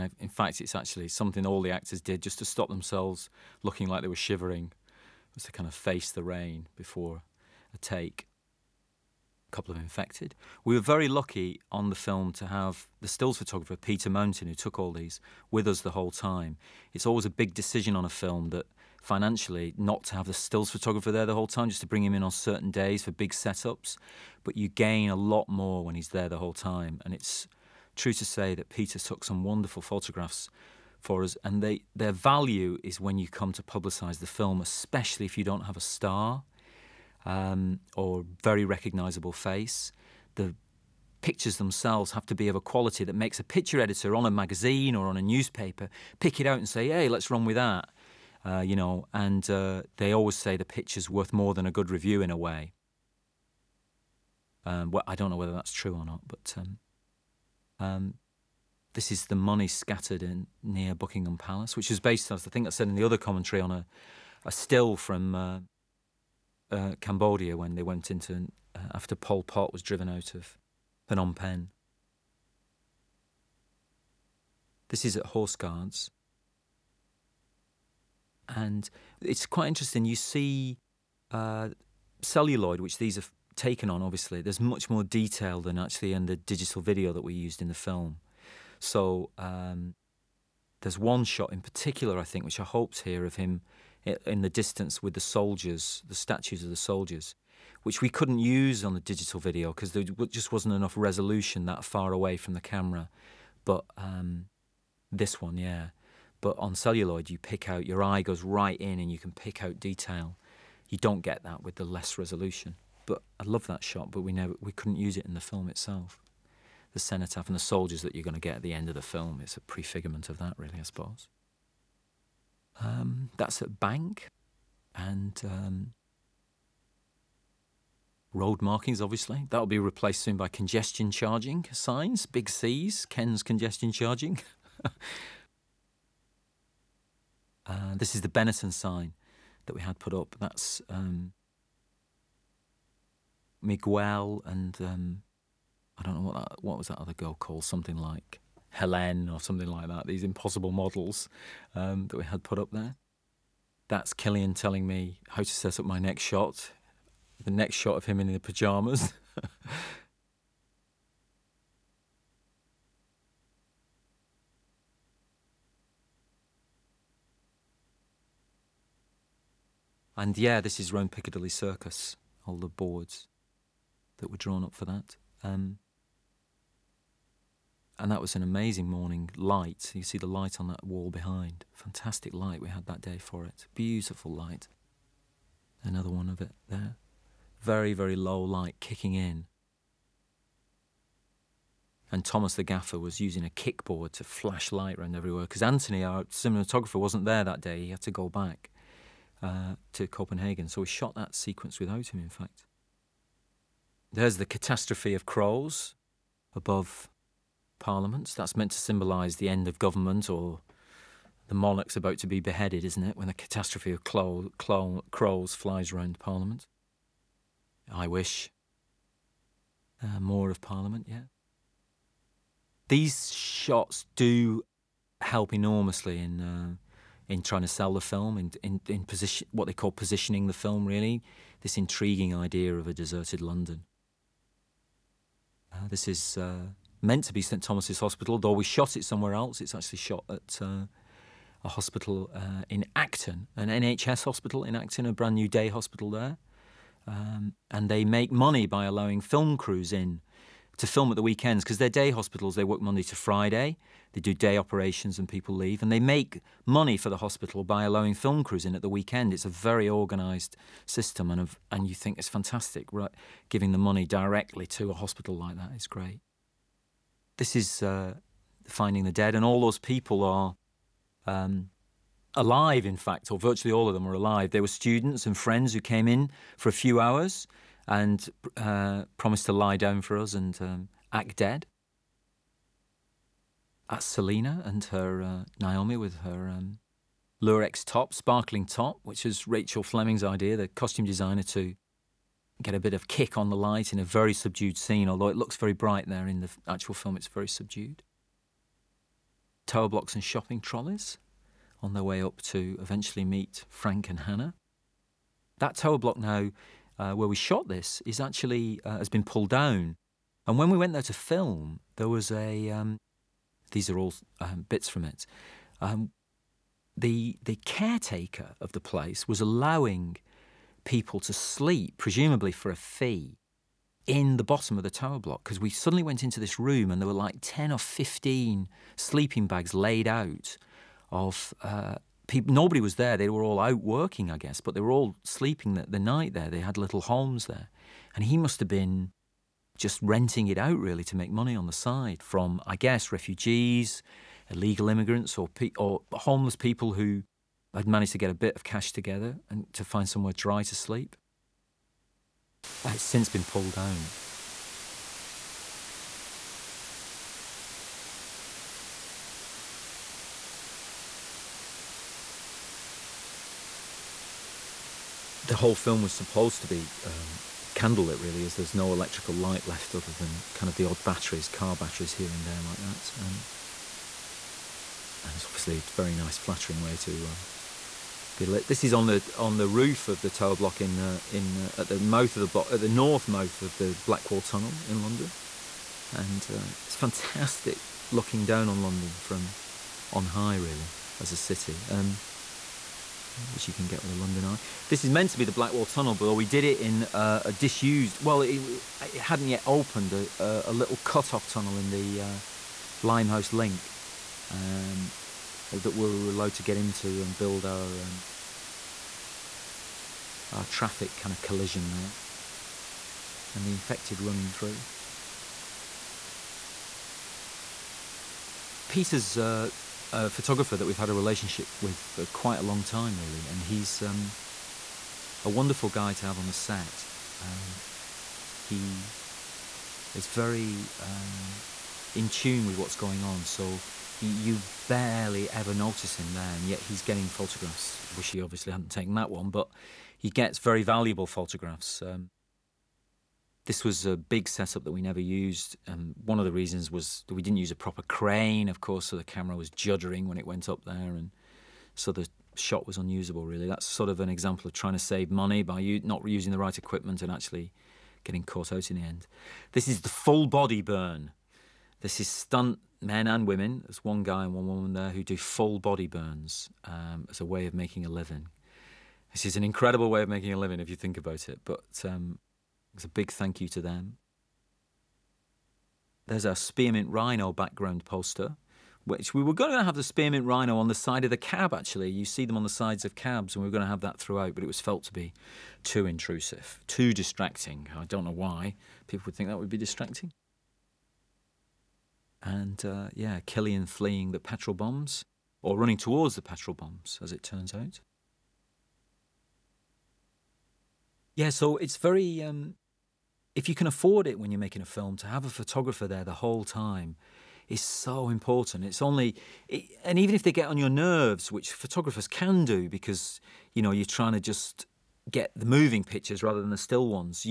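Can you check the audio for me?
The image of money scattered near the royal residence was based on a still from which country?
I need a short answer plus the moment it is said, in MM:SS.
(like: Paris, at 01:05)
Cambodia, at 01:07.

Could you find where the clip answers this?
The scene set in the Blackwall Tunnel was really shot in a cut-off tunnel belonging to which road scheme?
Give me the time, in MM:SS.
06:42.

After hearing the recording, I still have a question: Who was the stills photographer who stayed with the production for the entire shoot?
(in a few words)
Peter Mountain.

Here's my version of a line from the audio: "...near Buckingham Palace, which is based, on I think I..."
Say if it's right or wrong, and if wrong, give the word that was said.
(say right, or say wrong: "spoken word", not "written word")
right.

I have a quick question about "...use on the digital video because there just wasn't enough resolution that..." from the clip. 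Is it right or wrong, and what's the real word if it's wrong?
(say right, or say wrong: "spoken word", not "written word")
right.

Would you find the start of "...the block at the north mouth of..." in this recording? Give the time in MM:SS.
06:22.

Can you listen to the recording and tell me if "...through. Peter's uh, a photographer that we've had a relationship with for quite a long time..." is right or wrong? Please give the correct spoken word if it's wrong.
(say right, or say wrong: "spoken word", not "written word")
right.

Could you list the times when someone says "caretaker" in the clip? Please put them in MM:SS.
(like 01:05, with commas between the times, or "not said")
05:17.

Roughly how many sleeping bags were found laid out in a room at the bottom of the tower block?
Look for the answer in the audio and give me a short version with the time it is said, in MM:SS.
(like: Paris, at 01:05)
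10 or 15, at 05:27.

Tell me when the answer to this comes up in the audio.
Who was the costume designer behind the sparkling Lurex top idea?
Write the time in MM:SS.
04:49.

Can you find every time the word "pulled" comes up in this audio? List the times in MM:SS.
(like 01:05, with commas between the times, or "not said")
05:09, 05:53.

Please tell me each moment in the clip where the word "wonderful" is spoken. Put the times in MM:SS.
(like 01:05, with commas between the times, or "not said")
00:29, 07:05.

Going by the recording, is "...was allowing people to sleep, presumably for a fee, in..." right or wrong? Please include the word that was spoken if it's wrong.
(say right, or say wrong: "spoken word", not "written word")
right.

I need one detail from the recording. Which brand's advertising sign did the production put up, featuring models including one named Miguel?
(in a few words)
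Benetton.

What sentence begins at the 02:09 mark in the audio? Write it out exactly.
That'll be replaced soon by congestion charging signs, big C's, Ken's congestion charging.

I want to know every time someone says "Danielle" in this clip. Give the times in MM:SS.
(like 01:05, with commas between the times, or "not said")
not said.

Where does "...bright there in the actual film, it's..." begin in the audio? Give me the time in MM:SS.
04:55.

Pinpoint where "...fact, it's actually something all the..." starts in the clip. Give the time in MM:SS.
00:00.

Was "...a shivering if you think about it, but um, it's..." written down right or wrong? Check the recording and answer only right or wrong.
wrong.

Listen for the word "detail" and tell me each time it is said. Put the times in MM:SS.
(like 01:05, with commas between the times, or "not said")
01:25, 01:49.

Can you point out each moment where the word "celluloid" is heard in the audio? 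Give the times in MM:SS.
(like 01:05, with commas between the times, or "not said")
01:22, 01:46.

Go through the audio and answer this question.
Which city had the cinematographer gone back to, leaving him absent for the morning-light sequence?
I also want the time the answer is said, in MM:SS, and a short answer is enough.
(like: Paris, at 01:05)
Copenhagen, at 03:20.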